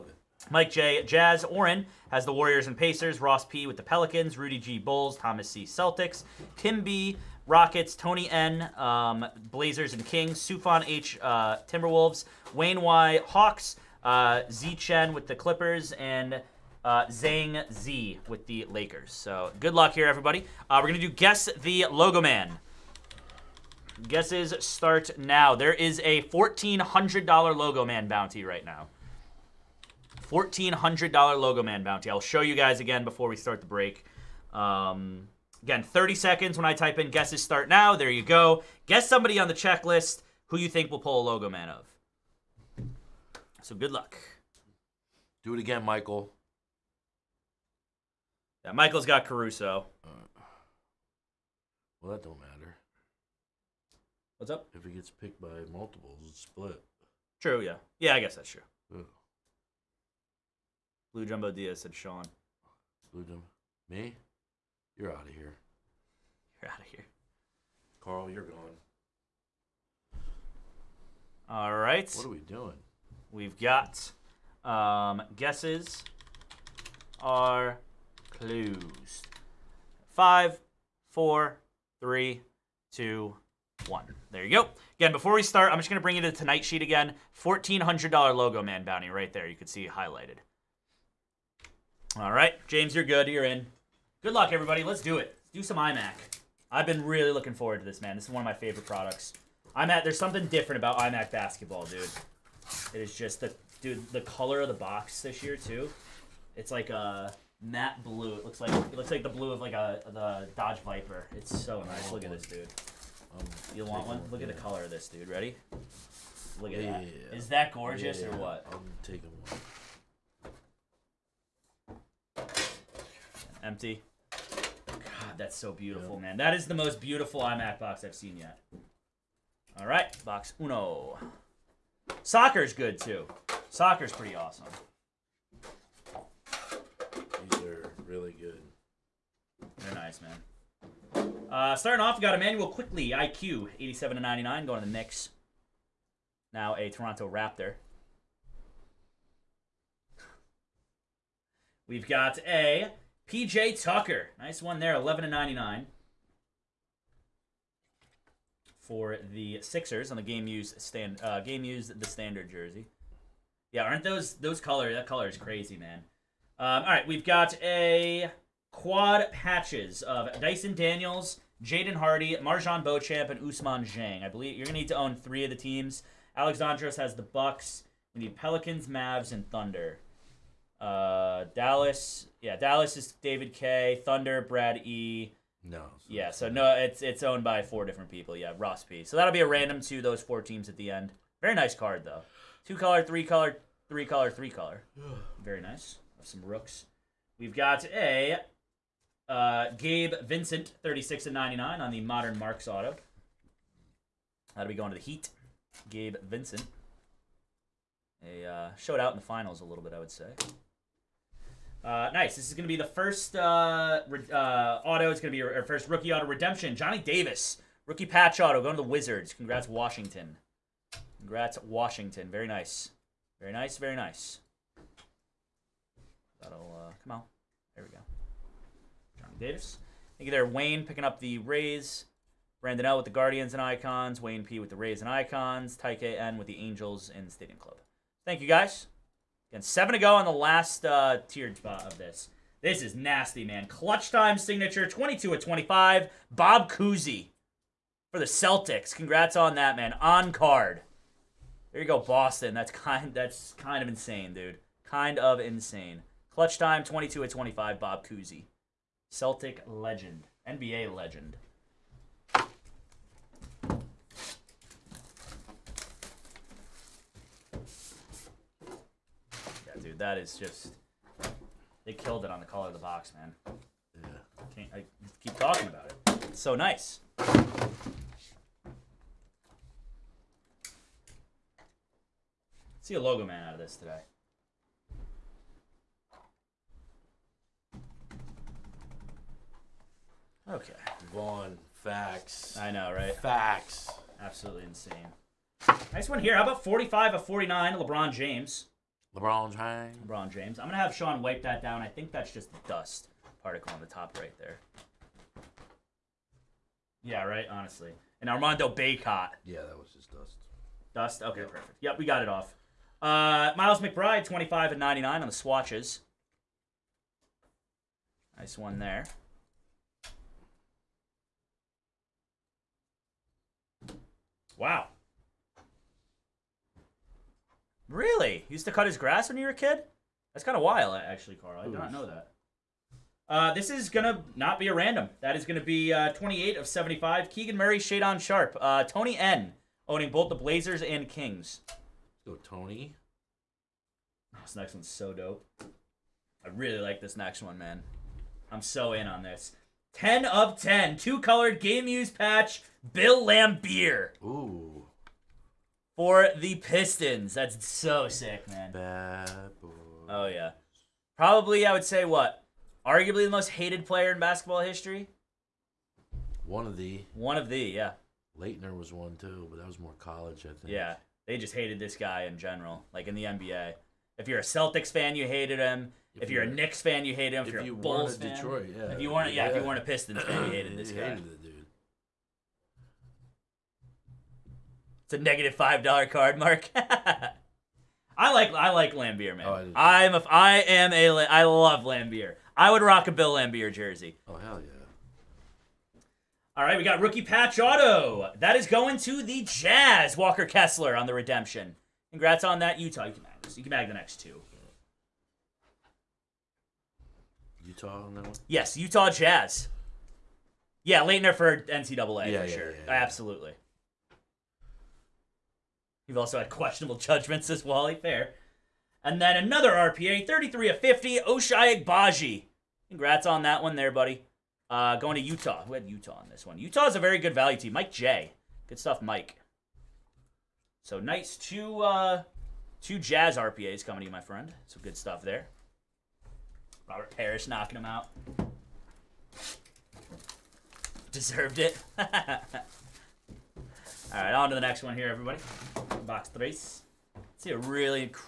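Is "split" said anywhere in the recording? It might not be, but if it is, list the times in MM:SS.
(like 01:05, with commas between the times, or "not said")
00:56.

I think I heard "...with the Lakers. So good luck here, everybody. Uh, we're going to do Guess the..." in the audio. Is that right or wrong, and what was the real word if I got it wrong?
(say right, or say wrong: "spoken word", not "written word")
right.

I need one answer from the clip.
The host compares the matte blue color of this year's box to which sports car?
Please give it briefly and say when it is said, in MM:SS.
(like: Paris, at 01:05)
Dodge Viper, at 01:50.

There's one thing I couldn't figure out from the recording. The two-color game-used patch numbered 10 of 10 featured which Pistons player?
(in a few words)
Bill Laimbeer.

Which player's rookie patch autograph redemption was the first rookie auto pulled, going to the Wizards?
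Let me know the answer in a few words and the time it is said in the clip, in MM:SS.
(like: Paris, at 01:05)
Johnny Davis, at 03:36.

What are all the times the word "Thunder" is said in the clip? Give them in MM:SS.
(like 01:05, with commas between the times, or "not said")
02:59, 03:04.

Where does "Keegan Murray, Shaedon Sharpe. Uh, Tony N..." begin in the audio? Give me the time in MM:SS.
05:37.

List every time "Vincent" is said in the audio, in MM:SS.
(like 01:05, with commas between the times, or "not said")
03:20, 03:26.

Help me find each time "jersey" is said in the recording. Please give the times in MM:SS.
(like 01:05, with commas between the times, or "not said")
02:42, 06:33.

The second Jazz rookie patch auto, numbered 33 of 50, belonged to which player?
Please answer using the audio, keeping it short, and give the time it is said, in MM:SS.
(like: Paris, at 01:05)
Ochai Agbaji, at 07:01.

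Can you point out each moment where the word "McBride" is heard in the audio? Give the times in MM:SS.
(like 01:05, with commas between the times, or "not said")
05:13.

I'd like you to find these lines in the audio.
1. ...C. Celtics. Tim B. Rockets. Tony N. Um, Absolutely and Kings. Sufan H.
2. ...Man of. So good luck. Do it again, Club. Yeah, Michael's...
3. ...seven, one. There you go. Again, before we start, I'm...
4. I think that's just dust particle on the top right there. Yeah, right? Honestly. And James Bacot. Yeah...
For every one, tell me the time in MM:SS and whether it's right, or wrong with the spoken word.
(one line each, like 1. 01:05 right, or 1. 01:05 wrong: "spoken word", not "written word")
1. 00:05 wrong: "Blazers", not "Absolutely"
2. 00:41 wrong: "Michael", not "Club"
3. 01:22 wrong: "two", not "seven"
4. 05:01 wrong: "Armando", not "James".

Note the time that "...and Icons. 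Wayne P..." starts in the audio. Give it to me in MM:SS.
03:53.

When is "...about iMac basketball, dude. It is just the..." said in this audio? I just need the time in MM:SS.
01:40.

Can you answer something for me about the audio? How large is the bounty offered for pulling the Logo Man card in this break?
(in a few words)
$1,400.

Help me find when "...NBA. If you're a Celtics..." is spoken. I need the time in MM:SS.
06:13.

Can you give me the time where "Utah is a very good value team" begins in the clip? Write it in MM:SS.
07:06.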